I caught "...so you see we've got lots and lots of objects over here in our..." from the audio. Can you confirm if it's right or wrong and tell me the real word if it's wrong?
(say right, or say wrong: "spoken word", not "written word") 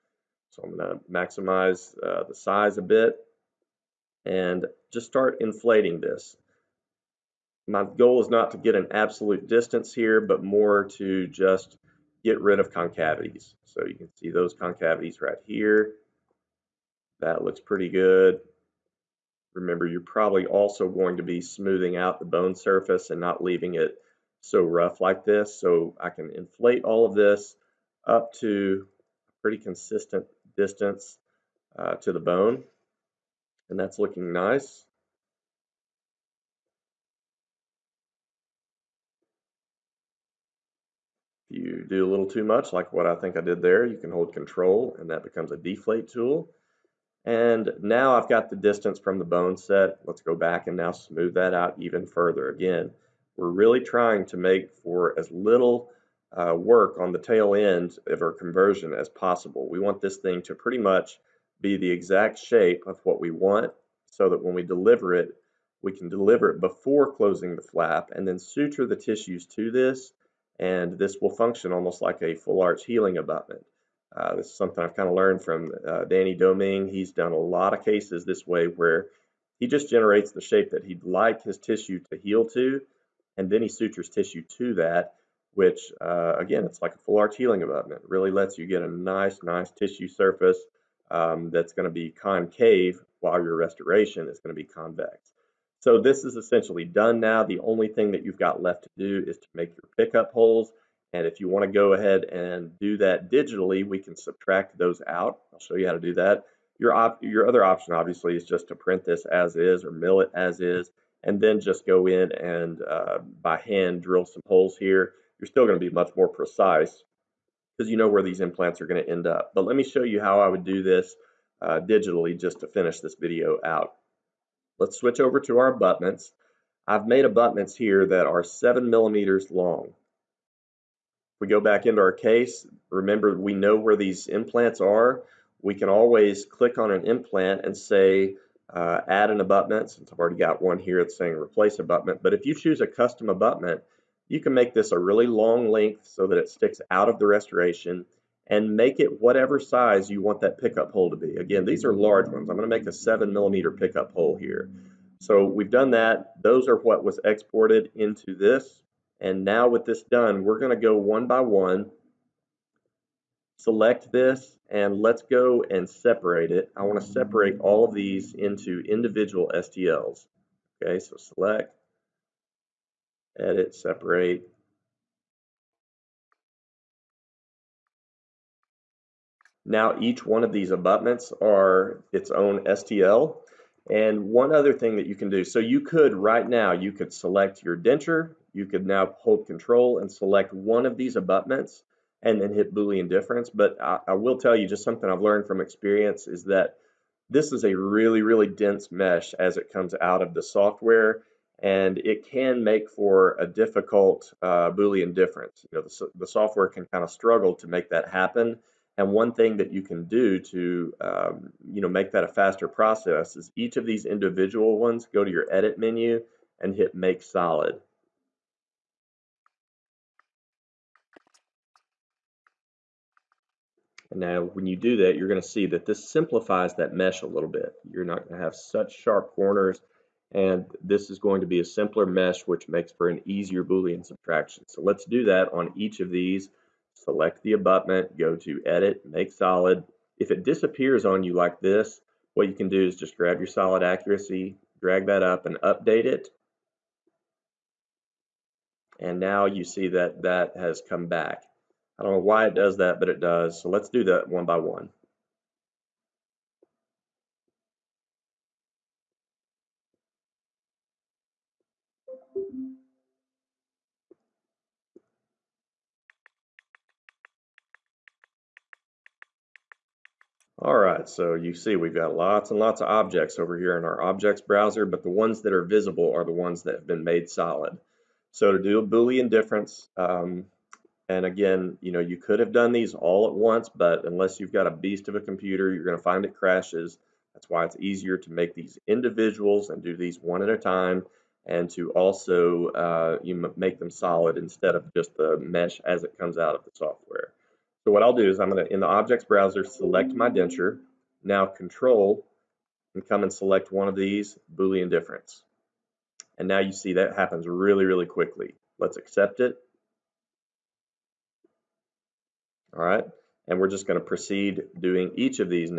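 right.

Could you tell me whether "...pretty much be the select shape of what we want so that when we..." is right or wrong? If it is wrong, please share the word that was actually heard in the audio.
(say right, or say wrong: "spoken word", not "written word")
wrong: "exact", not "select".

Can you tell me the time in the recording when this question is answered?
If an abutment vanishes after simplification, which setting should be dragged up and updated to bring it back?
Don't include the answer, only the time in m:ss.
4:03.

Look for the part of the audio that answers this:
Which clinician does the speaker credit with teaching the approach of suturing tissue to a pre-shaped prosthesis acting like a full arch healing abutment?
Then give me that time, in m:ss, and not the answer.
1:16.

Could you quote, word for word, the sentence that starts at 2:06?
I've made abutments here that are seven millimeters long.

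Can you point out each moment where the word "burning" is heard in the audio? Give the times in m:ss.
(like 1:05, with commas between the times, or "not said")
not said.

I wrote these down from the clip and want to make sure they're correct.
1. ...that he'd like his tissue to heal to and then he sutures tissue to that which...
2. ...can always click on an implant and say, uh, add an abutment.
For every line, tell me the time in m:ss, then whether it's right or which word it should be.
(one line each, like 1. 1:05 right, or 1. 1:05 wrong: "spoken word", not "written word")
1. 1:20 right
2. 2:15 right.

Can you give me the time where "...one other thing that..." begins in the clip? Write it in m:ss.
3:04.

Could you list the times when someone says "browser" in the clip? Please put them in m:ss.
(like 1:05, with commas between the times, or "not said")
4:34, 4:59.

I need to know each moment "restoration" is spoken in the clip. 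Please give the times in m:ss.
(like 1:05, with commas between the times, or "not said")
1:33, 2:27.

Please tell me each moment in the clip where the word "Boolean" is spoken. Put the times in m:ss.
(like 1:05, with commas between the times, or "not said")
3:12, 3:24, 3:53, 4:38, 5:04.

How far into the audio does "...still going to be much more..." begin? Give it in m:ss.
1:55.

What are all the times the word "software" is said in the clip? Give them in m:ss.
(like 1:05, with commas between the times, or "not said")
3:20, 3:26, 4:56.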